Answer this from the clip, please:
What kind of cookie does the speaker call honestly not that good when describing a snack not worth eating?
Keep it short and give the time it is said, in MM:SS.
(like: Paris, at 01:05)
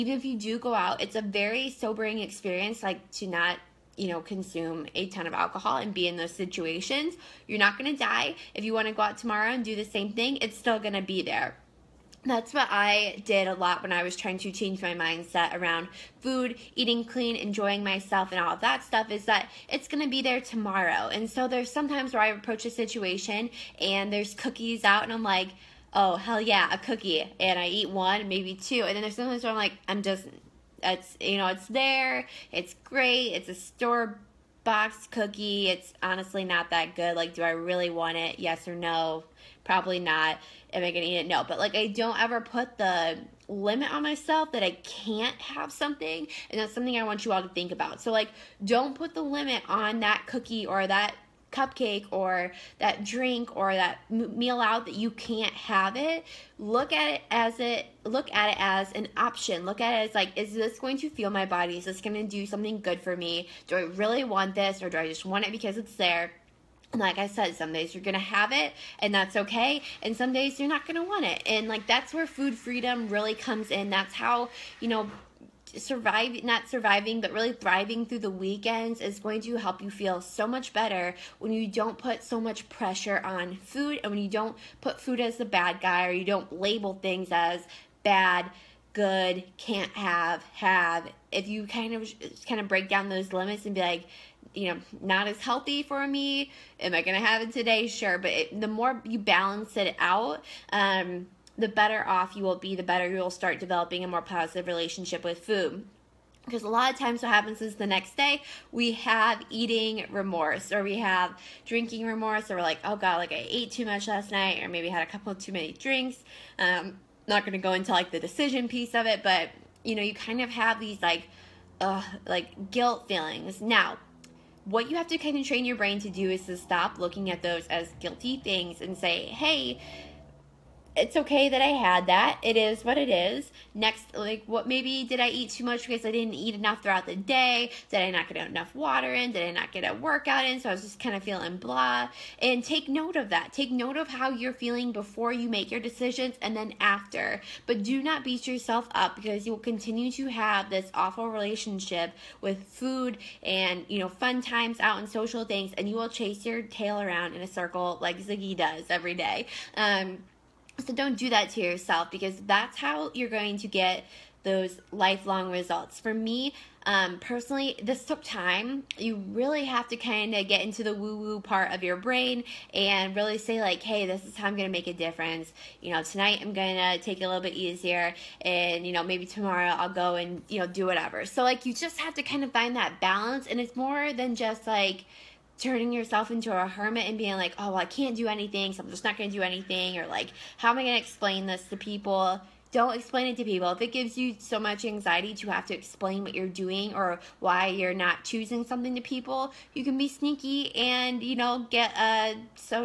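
store box cookie, at 00:33.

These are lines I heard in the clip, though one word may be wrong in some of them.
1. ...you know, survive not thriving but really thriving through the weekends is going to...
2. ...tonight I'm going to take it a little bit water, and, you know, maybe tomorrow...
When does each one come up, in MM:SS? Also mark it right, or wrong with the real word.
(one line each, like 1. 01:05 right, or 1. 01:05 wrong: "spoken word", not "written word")
1. 01:14 wrong: "surviving", not "thriving"
2. 02:56 wrong: "easier", not "water".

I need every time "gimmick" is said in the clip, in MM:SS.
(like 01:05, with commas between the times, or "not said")
not said.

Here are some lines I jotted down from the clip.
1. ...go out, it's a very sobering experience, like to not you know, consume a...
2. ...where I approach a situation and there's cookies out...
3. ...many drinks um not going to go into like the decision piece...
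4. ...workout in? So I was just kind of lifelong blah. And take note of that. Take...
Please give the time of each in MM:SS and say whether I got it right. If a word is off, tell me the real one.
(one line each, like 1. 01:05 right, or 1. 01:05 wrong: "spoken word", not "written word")
1. 00:00 right
2. 00:22 right
3. 01:55 right
4. 02:19 wrong: "feeling", not "lifelong".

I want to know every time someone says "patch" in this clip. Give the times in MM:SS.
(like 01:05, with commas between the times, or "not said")
not said.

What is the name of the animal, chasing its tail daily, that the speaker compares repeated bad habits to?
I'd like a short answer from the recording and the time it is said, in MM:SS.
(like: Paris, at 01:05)
Ziggy, at 02:38.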